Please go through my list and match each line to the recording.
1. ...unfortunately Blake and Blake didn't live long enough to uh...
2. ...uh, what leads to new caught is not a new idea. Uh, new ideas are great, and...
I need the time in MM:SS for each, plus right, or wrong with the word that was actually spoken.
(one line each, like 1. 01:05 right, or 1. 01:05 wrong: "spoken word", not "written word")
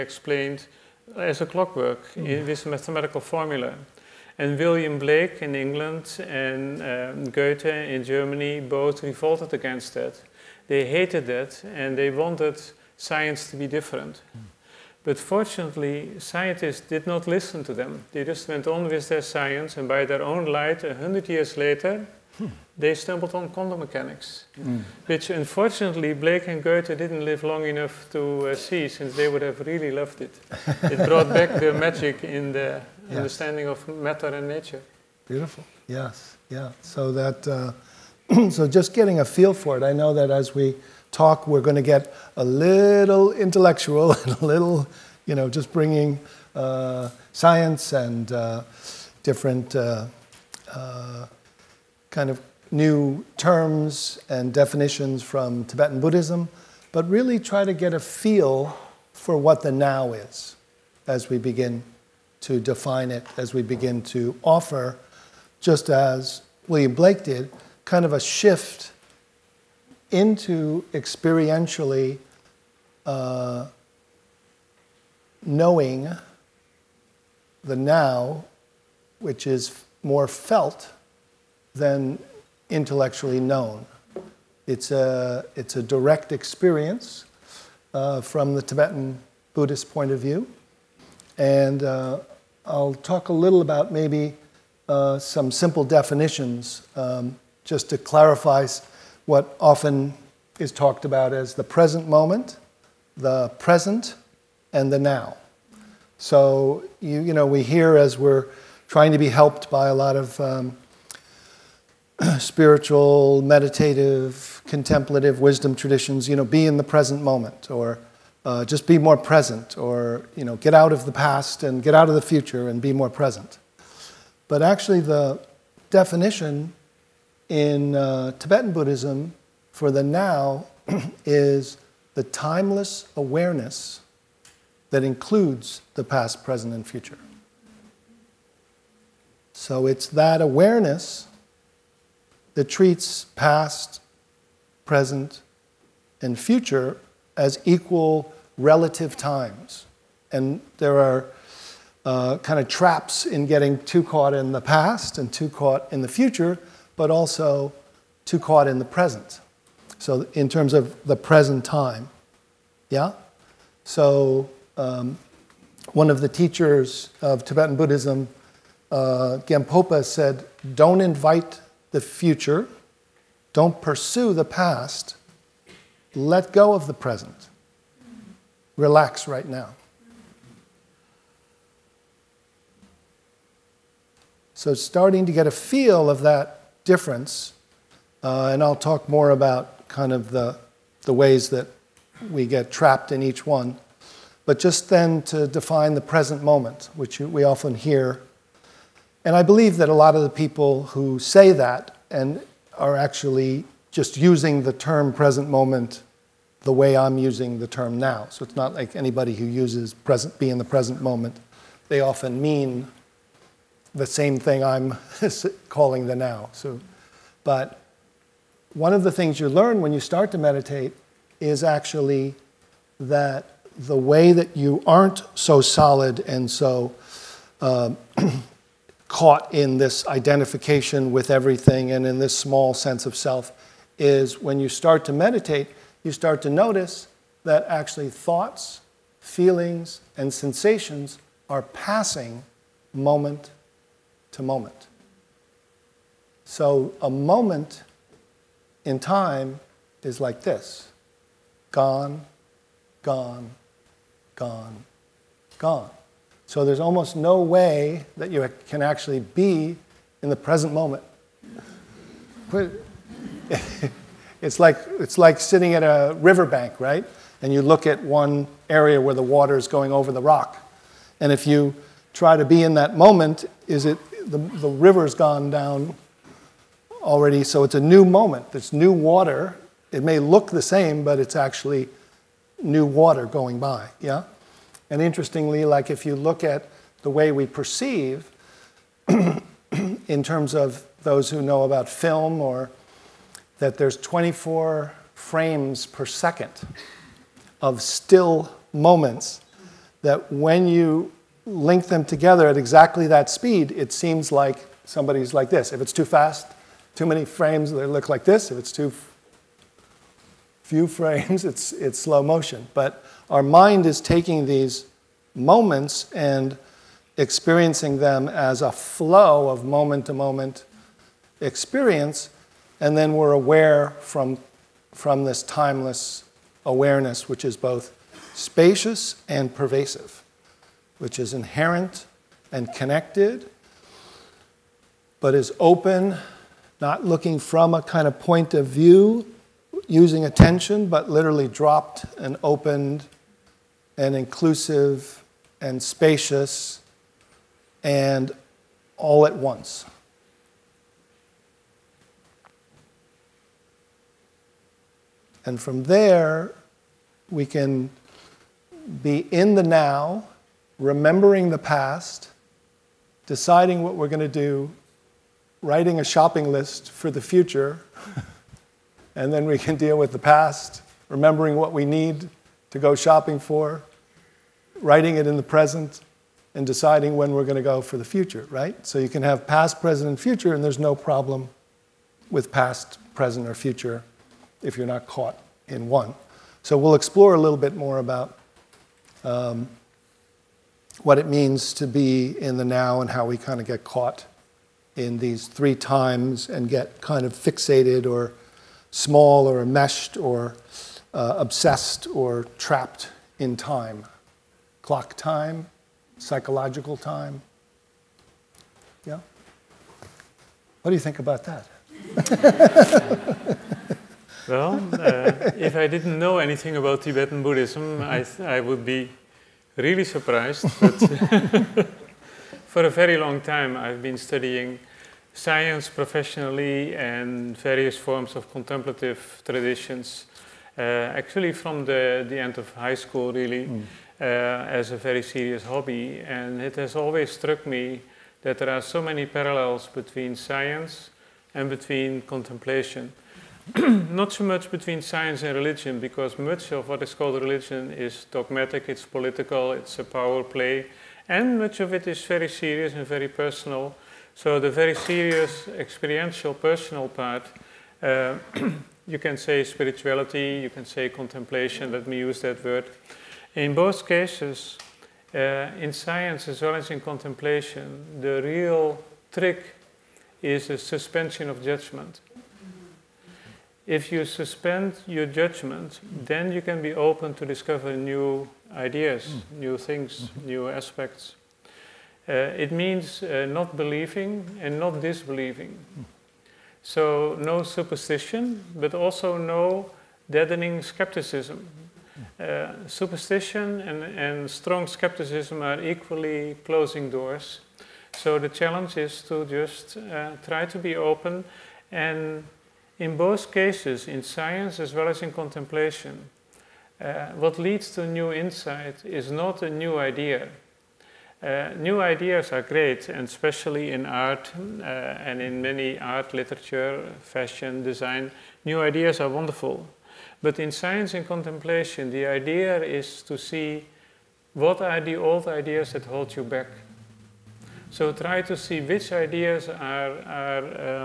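1. 00:25 wrong: "Goethe", not "Blake"
2. 08:26 wrong: "insight", not "caught".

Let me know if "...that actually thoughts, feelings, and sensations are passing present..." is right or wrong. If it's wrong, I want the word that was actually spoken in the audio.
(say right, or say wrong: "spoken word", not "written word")
wrong: "moment", not "present".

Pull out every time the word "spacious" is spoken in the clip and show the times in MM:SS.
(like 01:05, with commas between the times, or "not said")
05:28, 05:45.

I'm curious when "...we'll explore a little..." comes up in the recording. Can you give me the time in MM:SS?
06:26.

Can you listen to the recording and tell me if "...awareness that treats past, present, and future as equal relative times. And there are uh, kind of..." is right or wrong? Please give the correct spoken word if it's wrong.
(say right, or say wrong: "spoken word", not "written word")
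right.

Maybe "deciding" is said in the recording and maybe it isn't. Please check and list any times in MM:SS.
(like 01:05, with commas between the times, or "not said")
06:03, 06:16.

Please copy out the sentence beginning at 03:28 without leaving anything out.
So it's not like anybody who uses present, be in the present moment.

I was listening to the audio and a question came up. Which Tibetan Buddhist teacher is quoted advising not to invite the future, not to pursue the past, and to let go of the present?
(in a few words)
Gampopa.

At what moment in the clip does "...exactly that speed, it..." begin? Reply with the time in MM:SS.
05:02.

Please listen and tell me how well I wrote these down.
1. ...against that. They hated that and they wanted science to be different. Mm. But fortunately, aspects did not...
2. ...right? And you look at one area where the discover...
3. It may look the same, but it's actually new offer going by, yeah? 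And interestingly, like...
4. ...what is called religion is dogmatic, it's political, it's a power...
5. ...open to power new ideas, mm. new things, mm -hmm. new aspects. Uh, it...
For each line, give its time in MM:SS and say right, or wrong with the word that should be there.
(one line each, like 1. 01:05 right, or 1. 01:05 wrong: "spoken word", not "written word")
1. 00:09 wrong: "scientists", not "aspects"
2. 04:26 wrong: "water", not "discover"
3. 04:39 wrong: "water", not "offer"
4. 07:26 right
5. 07:56 wrong: "discover", not "power".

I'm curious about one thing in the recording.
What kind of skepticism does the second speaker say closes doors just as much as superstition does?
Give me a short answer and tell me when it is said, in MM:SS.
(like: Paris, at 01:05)
deadening skepticism, at 08:10.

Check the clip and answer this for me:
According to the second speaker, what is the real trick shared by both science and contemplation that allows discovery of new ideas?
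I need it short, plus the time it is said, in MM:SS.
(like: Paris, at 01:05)
suspension of judgment, at 07:50.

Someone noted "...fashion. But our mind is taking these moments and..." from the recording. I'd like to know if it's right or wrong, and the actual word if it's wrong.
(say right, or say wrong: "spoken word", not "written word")
wrong: "motion", not "fashion".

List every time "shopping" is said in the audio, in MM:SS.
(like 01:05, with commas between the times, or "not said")
06:06, 06:12.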